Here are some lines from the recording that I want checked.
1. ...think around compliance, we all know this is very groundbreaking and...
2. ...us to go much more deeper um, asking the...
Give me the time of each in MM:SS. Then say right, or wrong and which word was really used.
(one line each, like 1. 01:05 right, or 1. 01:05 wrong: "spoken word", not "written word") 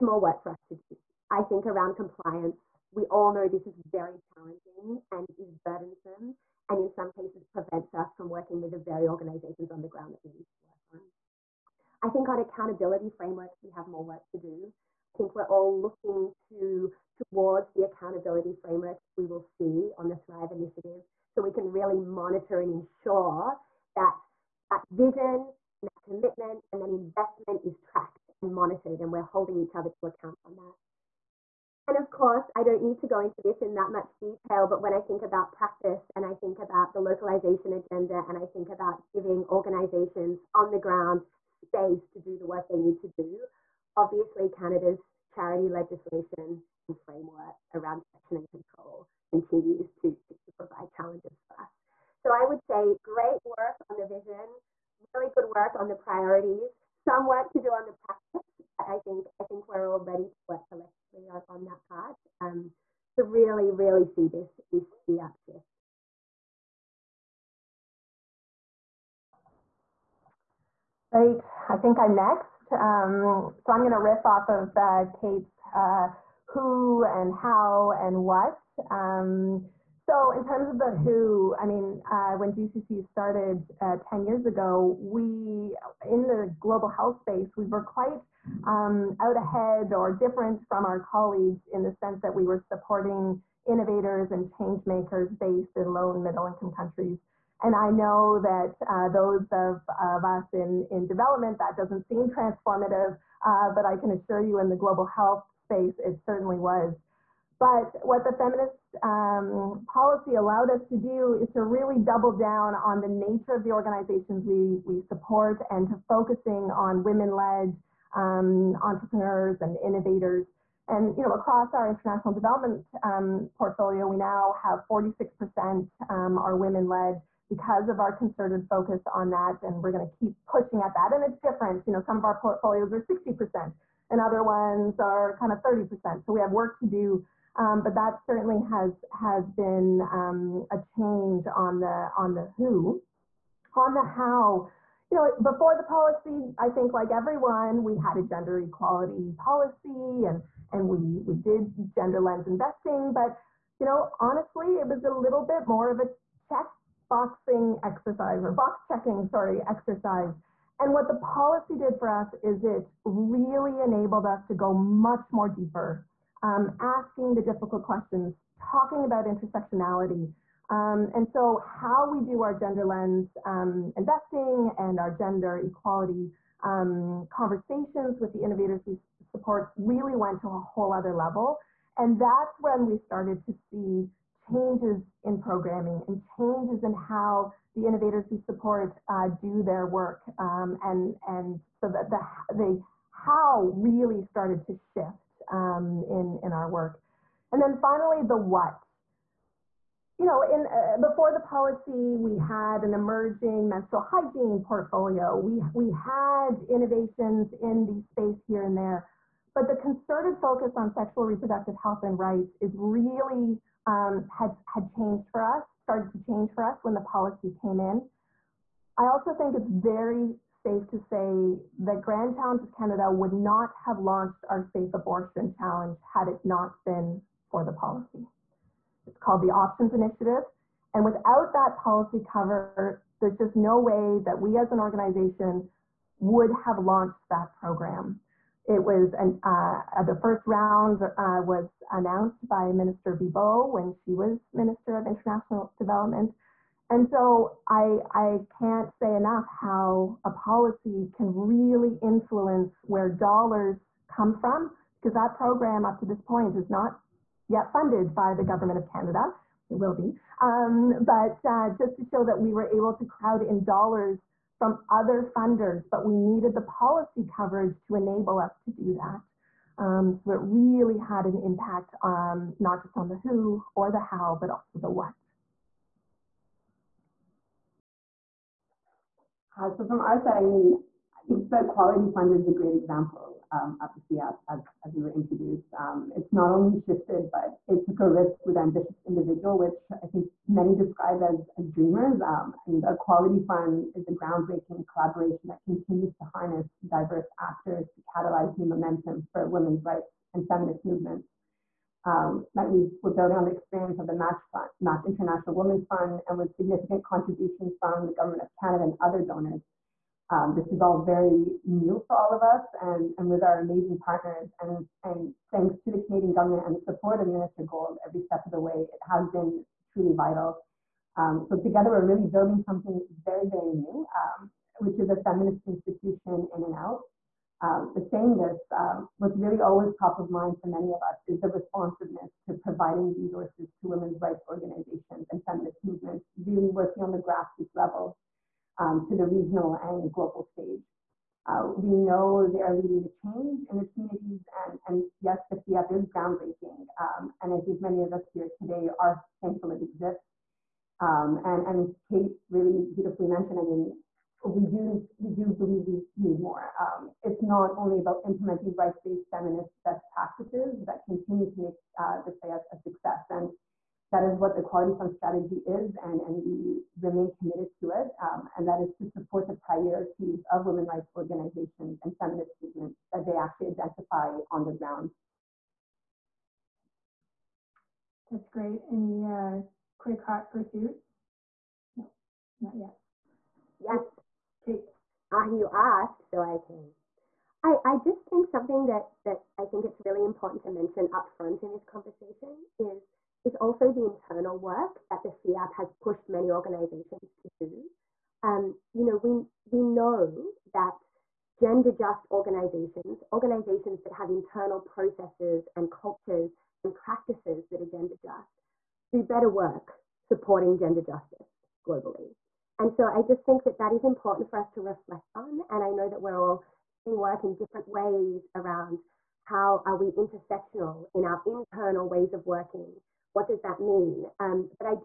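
1. 00:01 wrong: "challenging", not "groundbreaking"
2. 02:44 right.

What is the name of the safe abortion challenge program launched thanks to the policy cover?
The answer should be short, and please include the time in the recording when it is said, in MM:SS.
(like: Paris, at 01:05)
Options Initiative, at 03:49.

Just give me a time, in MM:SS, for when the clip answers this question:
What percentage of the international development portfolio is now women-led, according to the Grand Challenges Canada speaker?
02:04.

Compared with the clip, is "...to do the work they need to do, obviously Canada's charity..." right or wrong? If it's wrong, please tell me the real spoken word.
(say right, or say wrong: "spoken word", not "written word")
right.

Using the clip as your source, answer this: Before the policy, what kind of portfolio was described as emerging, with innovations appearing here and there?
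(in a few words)
menstrual hygiene.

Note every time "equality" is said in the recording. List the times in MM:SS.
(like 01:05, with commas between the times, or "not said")
02:28, 02:55, 04:41, 04:52, 06:04.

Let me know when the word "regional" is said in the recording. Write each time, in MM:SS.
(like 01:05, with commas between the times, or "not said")
05:39.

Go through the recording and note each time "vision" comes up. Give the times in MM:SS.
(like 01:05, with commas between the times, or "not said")
00:24, 00:54.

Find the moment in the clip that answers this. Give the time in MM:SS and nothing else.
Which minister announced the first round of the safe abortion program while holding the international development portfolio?
04:02.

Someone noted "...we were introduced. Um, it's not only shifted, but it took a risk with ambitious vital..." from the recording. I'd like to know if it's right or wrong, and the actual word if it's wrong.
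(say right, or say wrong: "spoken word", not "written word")
wrong: "individual", not "vital".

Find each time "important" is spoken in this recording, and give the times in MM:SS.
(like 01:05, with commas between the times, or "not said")
06:30, 06:54.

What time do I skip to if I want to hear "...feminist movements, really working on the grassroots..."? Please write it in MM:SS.
05:35.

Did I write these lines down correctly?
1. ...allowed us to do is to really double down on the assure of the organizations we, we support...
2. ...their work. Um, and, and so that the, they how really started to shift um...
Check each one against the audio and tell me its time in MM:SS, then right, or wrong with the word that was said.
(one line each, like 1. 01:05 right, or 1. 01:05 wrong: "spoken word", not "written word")
1. 01:50 wrong: "nature", not "assure"
2. 03:09 right.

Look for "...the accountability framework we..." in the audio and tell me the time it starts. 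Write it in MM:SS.
00:17.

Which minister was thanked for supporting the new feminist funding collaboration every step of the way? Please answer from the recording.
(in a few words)
Minister Gould.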